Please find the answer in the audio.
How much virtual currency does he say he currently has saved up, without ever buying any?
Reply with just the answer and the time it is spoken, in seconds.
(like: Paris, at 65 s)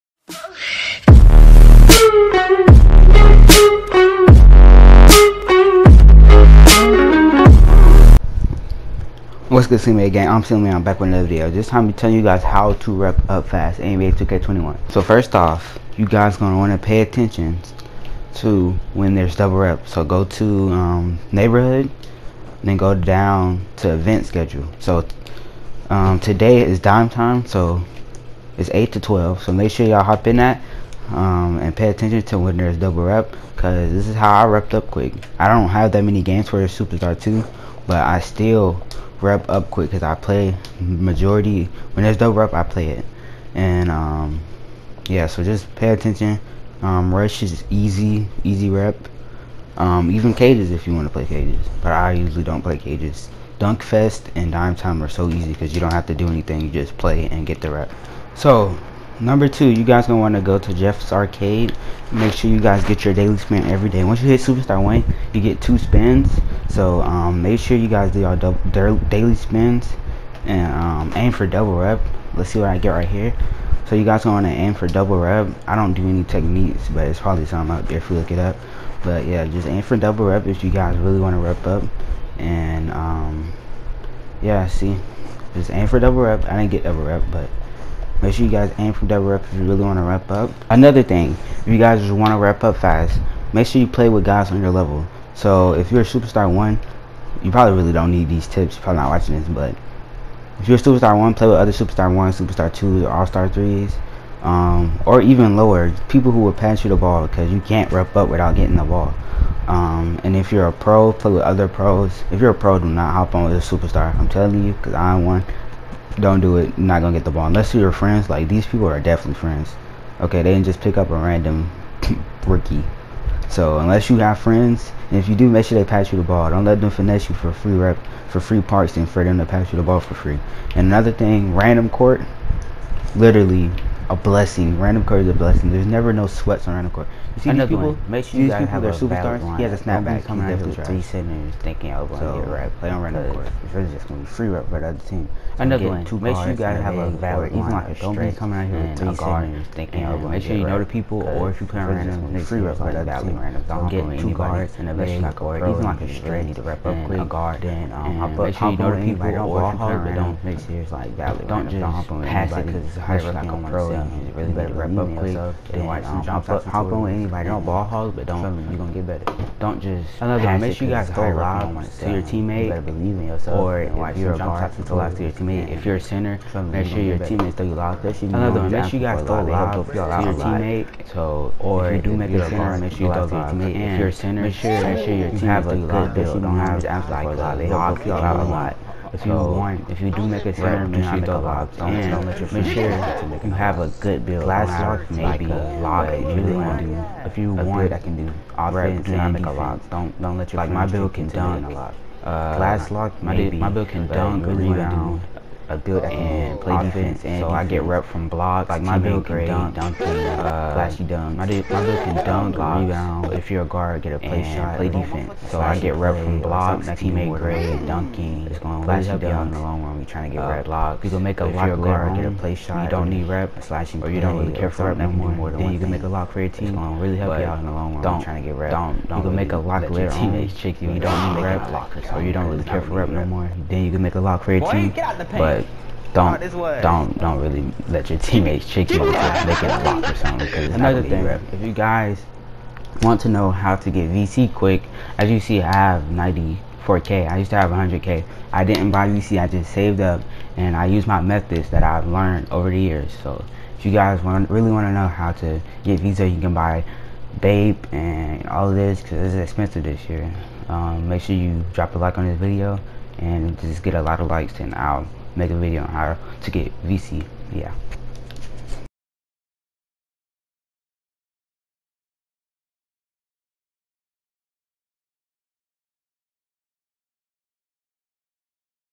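94k, at 246 s.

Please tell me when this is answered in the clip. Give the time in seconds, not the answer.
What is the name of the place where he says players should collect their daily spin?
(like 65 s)
60 s.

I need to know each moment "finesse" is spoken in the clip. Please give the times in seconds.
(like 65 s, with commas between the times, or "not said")
126 s.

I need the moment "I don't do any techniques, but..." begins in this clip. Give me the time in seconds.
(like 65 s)
75 s.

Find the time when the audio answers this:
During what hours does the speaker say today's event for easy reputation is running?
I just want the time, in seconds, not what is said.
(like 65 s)
28 s.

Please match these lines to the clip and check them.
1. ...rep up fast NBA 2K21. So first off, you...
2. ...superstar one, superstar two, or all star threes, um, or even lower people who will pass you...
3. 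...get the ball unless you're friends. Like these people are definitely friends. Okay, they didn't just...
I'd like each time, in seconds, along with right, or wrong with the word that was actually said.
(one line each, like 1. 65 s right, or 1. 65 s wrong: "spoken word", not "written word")
1. 12 s right
2. 101 s right
3. 117 s right.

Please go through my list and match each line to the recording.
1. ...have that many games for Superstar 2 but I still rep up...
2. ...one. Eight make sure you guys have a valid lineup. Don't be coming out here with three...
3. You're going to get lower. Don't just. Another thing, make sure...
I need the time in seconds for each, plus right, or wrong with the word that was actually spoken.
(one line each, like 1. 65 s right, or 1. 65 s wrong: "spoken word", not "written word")
1. 35 s right
2. 145 s wrong: "Two", not "Eight"
3. 168 s wrong: "better", not "lower".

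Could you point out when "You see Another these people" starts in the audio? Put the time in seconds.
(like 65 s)
137 s.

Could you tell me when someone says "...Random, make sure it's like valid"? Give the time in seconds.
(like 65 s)
160 s.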